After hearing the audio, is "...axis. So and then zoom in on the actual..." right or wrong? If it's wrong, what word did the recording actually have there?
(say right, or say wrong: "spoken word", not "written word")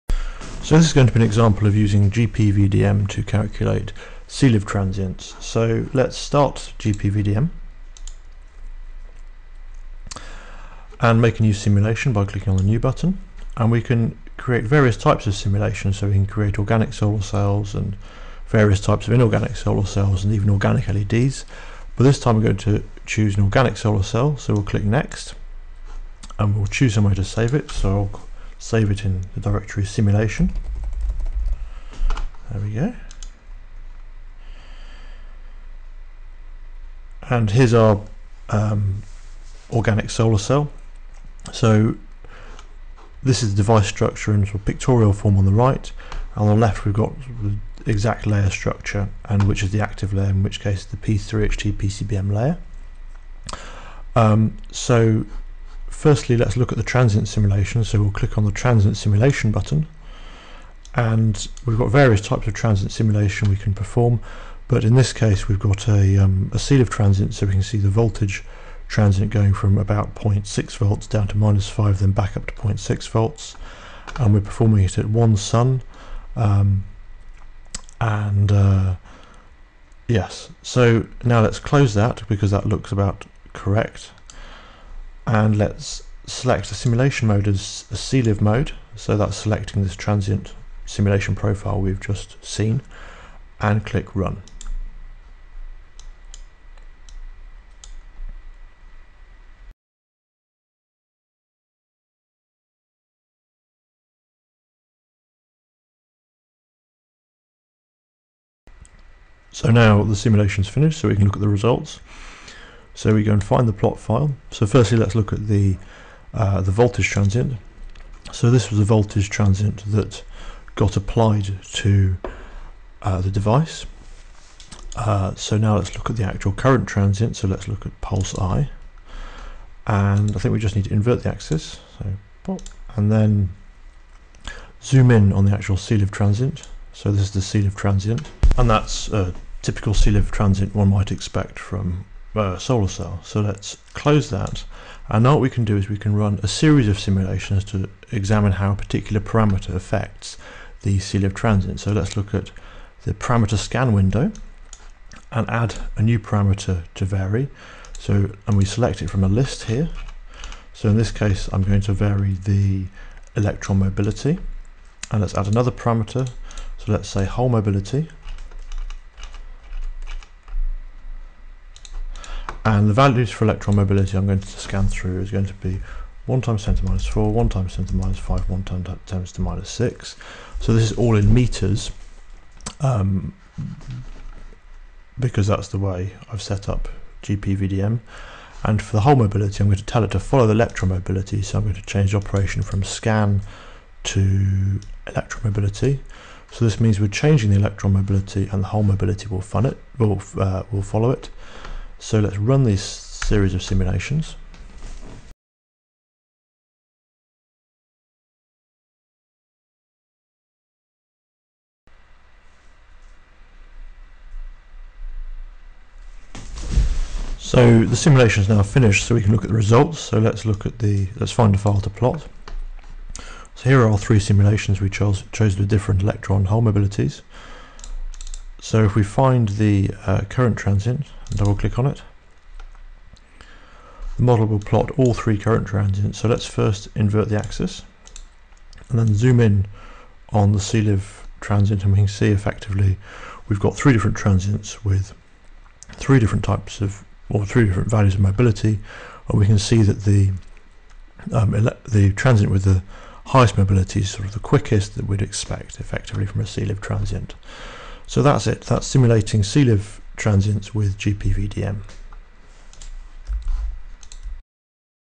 right.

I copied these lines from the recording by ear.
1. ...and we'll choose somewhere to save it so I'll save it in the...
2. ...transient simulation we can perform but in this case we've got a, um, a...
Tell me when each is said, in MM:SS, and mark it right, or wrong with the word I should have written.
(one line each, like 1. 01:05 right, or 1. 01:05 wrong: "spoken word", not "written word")
1. 00:26 right
2. 01:02 right.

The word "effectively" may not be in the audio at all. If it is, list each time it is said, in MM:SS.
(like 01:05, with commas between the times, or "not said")
04:02, 04:15.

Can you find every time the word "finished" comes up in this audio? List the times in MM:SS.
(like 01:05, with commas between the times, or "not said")
01:50, 03:38.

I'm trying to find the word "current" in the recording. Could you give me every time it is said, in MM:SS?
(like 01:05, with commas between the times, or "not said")
02:06, 03:50, 03:55.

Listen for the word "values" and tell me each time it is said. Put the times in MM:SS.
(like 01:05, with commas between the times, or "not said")
02:52, 04:07.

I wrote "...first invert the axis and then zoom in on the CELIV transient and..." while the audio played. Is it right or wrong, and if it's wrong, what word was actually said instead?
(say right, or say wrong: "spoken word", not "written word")
right.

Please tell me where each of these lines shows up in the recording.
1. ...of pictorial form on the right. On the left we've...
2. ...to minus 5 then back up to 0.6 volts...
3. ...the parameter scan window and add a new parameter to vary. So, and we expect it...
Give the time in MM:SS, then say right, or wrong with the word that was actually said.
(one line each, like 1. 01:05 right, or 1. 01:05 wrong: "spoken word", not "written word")
1. 00:44 right
2. 01:11 right
3. 02:33 wrong: "select", not "expect".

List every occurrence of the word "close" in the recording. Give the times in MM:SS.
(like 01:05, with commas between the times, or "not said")
01:21, 02:23.